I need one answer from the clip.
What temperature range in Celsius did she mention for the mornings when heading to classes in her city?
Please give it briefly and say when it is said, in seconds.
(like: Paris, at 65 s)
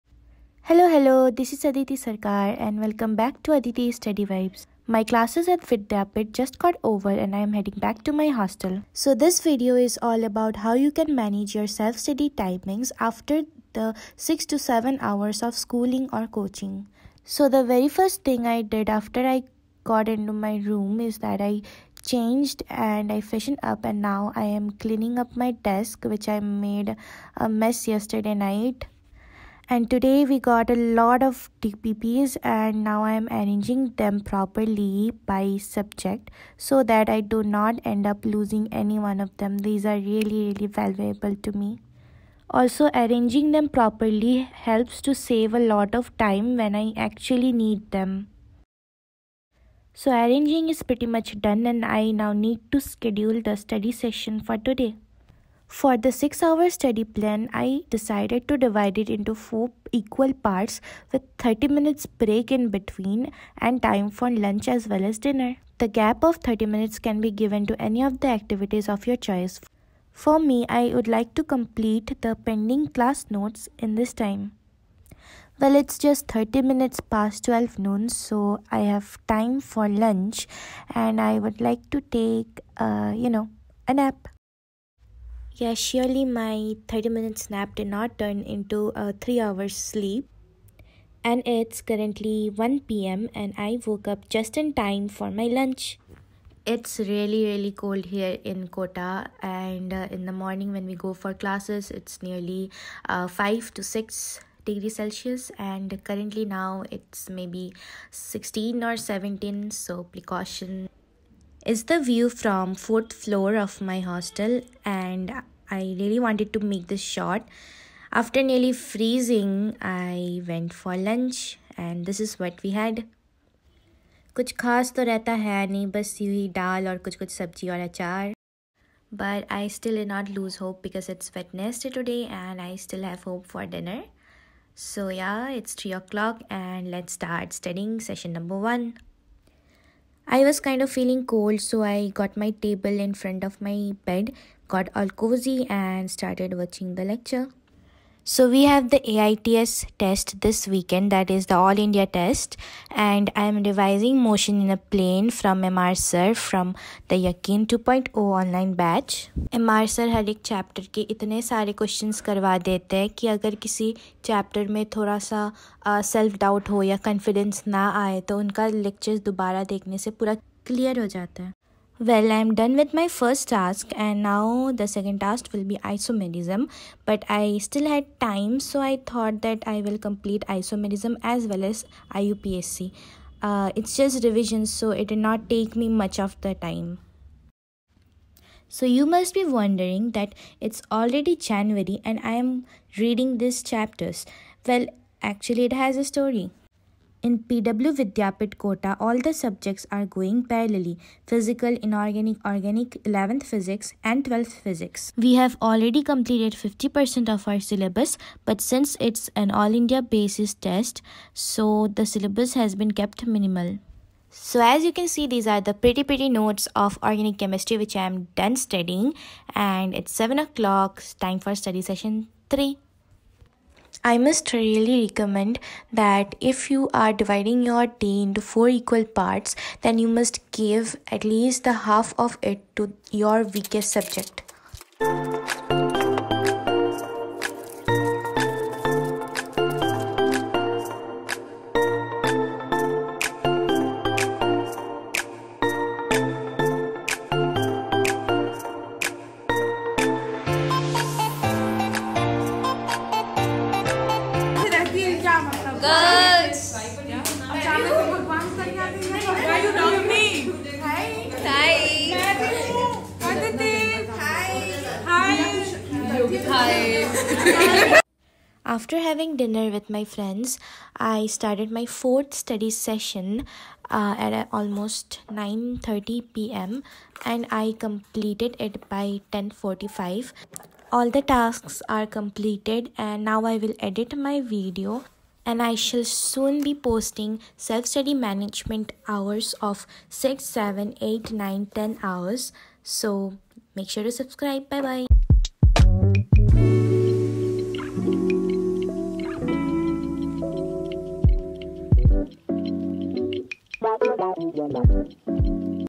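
5 to 6 degrees, at 103 s.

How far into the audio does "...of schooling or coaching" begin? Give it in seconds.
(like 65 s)
15 s.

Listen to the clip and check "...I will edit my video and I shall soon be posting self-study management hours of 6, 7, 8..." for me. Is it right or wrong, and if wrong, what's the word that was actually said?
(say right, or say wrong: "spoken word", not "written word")
right.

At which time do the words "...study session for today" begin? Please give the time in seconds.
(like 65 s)
53 s.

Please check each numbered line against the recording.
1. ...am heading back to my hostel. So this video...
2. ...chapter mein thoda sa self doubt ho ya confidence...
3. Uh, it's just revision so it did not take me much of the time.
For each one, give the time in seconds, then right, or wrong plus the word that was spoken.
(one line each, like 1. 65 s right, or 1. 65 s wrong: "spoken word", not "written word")
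1. 7 s right
2. 164 s right
3. 183 s right.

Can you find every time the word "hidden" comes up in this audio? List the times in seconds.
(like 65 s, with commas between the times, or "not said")
not said.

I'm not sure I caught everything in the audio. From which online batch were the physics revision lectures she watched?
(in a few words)
Yakin 2.0.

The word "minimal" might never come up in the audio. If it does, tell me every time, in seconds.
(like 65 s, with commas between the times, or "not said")
213 s.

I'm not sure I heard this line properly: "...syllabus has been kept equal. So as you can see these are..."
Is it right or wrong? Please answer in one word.
wrong.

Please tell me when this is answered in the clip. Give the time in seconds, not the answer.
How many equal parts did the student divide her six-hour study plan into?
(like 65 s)
59 s.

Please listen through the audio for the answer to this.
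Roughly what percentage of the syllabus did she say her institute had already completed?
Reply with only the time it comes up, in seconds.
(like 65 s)
206 s.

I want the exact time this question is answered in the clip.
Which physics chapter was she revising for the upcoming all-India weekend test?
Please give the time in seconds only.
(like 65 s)
154 s.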